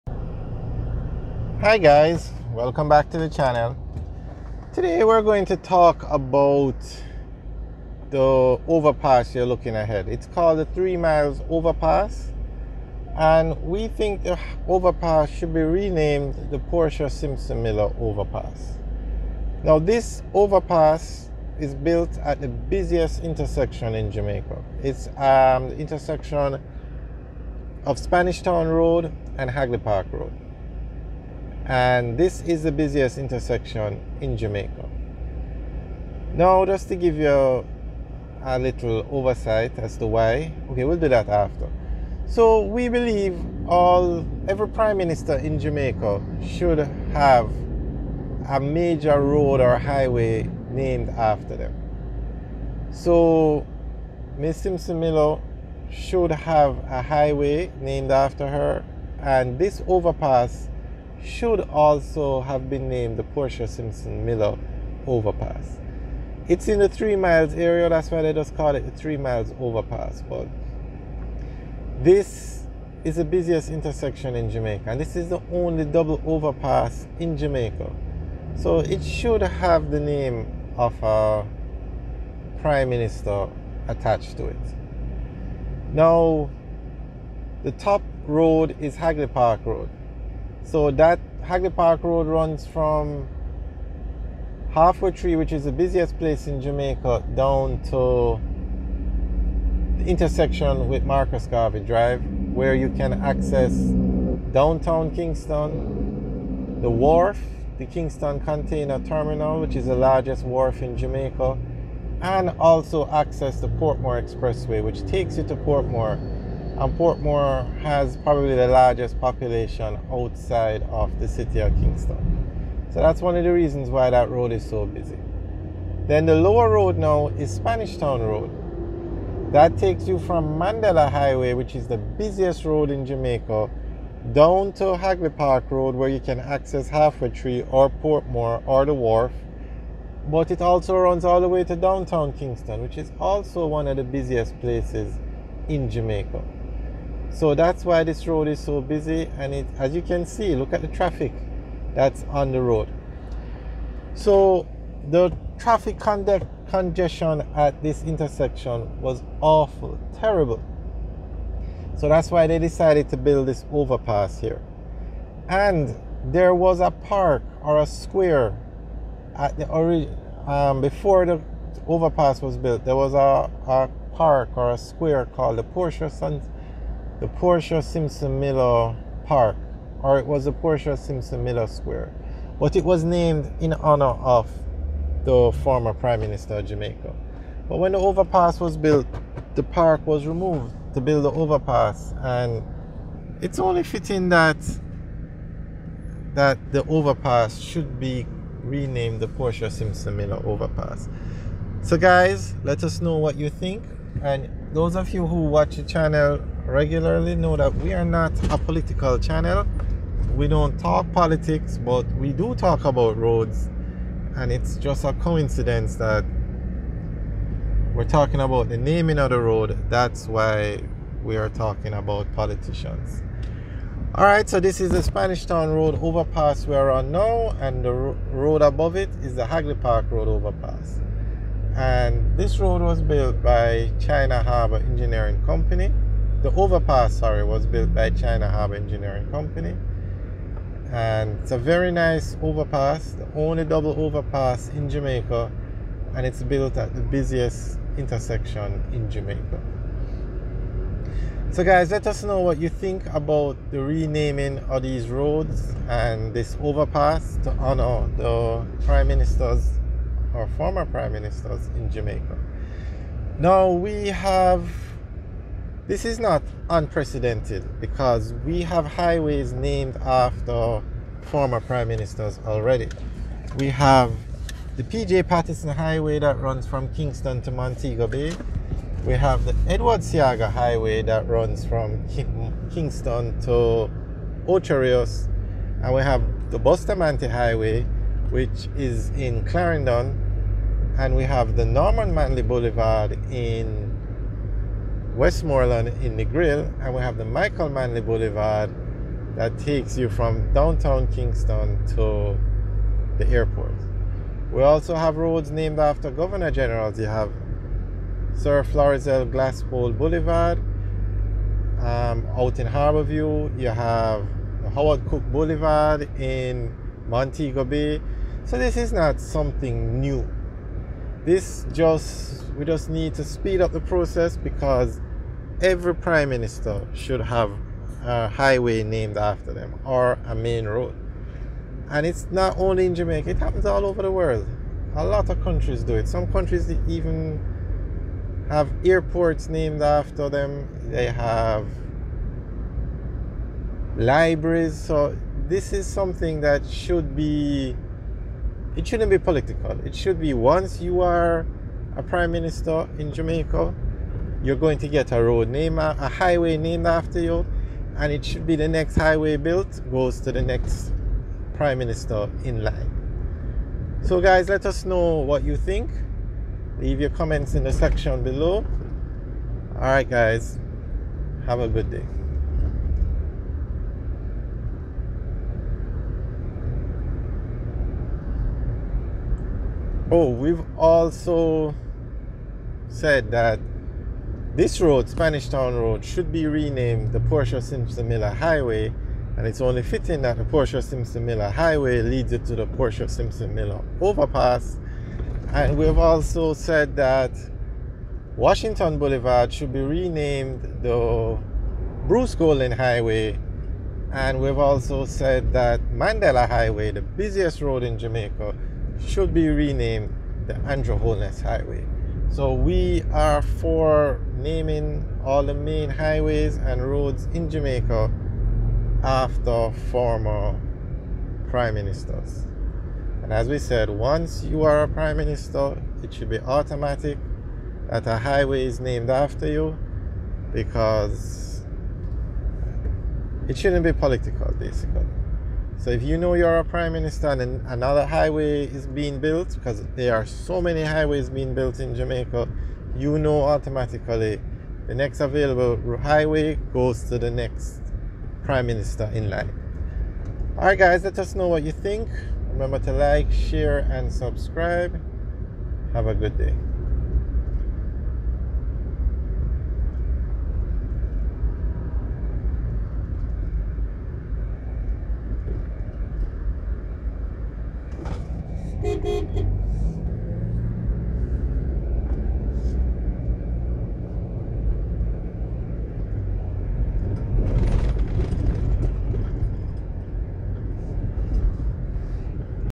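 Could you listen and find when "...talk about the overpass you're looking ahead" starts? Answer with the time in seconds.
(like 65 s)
5 s.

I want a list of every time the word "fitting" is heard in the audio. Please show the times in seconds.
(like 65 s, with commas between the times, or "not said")
193 s, 389 s.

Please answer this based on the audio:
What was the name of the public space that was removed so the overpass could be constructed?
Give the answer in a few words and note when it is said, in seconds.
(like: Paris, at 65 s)
Portia Miller Square, at 180 s.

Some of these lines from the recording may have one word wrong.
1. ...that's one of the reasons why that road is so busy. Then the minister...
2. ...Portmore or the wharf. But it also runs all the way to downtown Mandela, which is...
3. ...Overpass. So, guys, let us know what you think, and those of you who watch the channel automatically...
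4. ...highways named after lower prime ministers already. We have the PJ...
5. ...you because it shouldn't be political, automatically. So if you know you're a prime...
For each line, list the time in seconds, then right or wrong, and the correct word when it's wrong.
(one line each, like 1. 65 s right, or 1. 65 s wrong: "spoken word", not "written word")
1. 123 s wrong: "lower", not "minister"
2. 137 s wrong: "Kingston", not "Mandela"
3. 200 s wrong: "regularly", not "automatically"
4. 268 s wrong: "former", not "lower"
5. 429 s wrong: "basically", not "automatically".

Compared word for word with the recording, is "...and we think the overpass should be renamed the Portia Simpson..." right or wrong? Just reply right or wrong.
right.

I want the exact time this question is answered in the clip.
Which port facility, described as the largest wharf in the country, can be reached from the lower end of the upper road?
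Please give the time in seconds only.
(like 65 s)
107 s.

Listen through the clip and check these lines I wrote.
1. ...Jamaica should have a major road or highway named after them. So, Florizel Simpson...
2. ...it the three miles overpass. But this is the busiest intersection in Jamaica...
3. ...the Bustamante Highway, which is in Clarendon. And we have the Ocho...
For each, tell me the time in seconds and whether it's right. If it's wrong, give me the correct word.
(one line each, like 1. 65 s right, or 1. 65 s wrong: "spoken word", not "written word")
1. 45 s wrong: "Miss", not "Florizel"
2. 68 s right
3. 286 s wrong: "Norman", not "Ocho".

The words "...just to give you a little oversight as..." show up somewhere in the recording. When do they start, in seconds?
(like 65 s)
36 s.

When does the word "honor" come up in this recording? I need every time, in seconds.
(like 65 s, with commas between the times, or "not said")
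183 s, 257 s.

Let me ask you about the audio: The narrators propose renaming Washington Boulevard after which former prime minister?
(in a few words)
Bruce Golding.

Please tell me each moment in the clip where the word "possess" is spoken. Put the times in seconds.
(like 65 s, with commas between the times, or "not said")
not said.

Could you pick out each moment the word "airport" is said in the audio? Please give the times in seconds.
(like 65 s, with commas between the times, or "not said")
303 s, 338 s.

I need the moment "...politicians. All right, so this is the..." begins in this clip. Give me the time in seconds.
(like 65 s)
222 s.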